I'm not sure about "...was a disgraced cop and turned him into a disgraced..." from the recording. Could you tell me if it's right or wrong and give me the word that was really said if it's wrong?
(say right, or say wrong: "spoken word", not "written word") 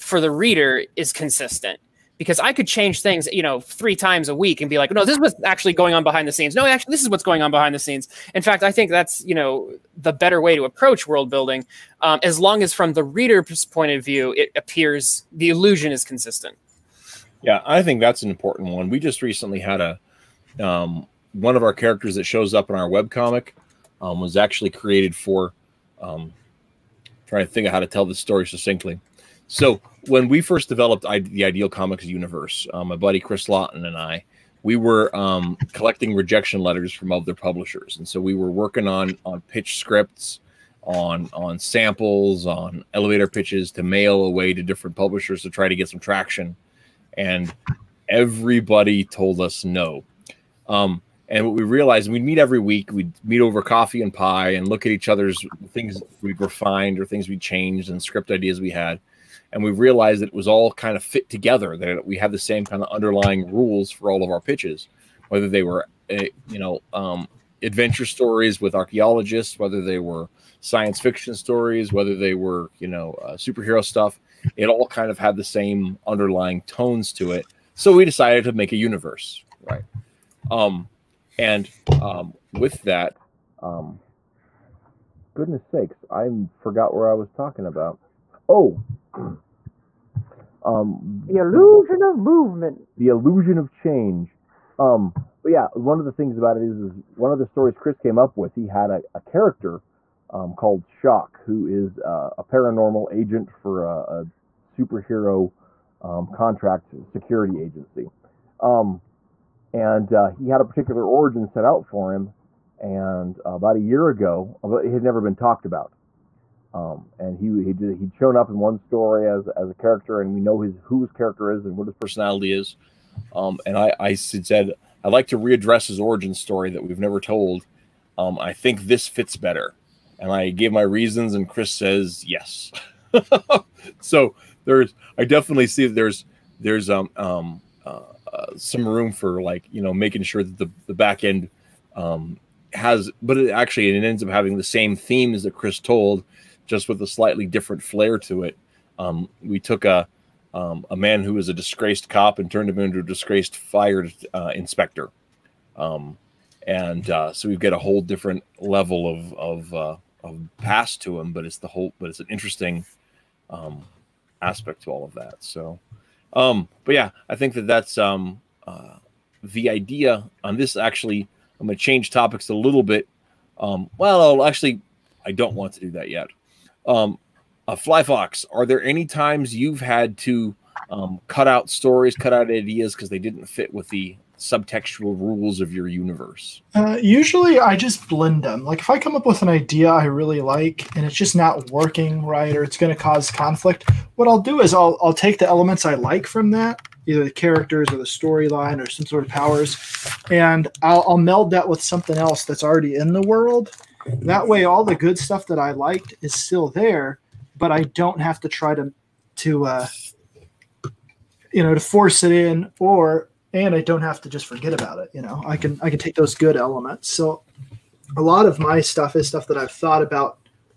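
right.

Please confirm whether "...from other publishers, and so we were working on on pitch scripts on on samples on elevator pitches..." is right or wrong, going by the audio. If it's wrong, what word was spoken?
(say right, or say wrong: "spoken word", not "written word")
right.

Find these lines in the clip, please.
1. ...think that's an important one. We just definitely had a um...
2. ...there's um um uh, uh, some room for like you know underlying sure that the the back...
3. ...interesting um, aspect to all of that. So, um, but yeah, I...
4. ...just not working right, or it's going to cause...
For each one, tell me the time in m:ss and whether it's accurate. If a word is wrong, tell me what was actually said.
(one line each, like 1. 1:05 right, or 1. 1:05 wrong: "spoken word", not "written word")
1. 0:17 wrong: "recently", not "definitely"
2. 2:16 wrong: "making", not "underlying"
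3. 2:42 right
4. 3:11 right.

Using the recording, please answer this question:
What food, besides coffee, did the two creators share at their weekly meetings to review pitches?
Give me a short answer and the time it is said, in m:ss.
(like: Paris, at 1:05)
pie, at 0:54.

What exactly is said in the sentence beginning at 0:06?
No, actually, this is what's going on behind the scenes.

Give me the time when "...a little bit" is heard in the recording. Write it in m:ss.
2:52.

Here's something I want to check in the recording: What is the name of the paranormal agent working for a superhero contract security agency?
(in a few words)
Shock.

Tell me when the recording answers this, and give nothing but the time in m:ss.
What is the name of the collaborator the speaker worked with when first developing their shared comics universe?
0:33.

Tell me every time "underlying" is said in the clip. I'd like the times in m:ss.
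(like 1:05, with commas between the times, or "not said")
1:02, 1:16.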